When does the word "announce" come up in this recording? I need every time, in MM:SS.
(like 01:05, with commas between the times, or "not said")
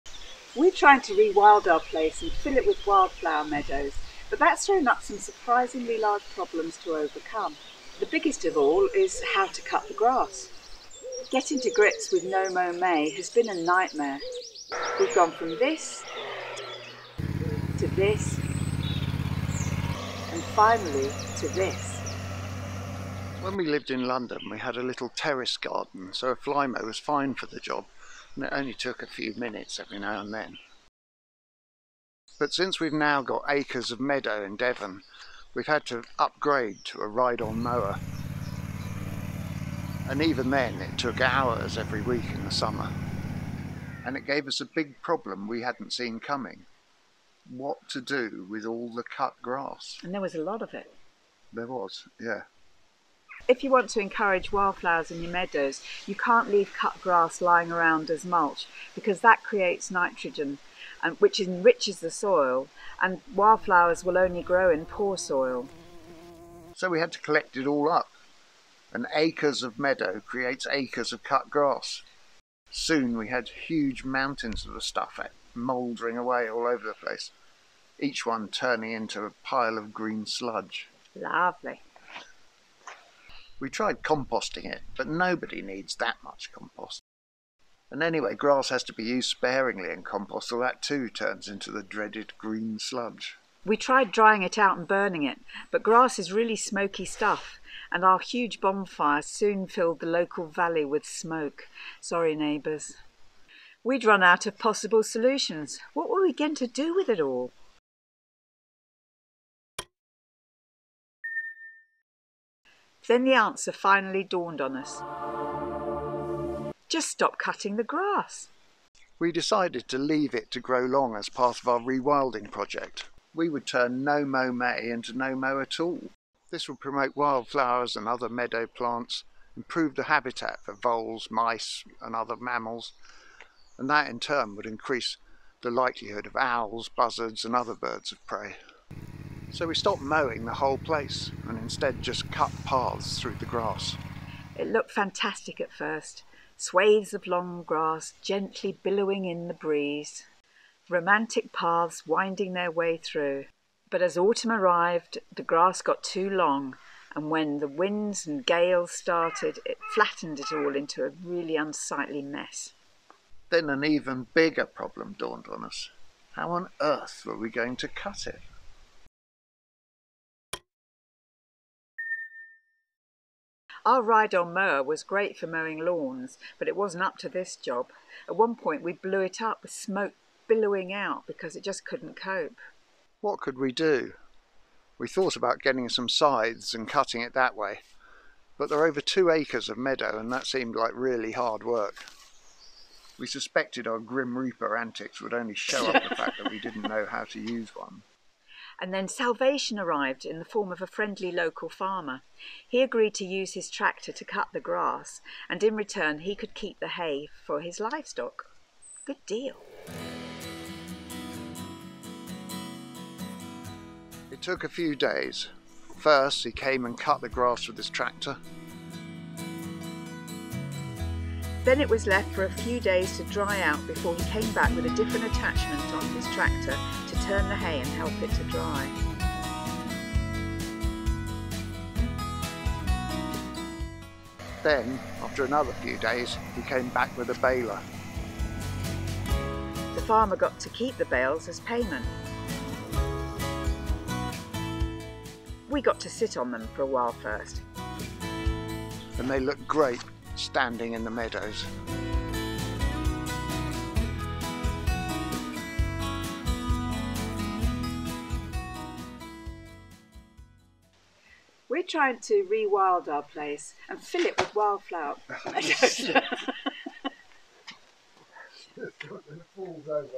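not said.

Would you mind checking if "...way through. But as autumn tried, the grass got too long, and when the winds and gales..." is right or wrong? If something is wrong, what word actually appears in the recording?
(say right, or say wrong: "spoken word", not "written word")
wrong: "arrived", not "tried".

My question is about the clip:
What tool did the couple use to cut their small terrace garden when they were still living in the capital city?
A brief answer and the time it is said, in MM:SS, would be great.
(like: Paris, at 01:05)
Flymo, at 00:26.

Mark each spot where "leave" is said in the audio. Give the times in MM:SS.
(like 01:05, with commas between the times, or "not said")
00:56, 01:59.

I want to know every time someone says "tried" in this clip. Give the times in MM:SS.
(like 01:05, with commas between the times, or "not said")
01:23, 01:33.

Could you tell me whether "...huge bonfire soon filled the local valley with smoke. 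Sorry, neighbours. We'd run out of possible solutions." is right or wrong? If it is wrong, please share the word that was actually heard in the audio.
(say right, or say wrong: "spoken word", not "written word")
right.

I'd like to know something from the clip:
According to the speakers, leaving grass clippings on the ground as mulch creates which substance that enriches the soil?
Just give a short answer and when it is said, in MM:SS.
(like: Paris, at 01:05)
Nitrogen, at 00:59.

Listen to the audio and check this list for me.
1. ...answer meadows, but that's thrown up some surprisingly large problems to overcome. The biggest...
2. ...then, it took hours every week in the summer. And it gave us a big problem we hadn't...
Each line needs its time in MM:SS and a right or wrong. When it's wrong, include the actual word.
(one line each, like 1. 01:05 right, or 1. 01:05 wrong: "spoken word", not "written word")
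1. 00:02 wrong: "wildflower", not "answer"
2. 00:40 right.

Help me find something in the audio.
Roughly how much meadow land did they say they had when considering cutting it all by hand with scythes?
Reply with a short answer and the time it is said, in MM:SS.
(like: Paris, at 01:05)
Over 2 acres, at 03:08.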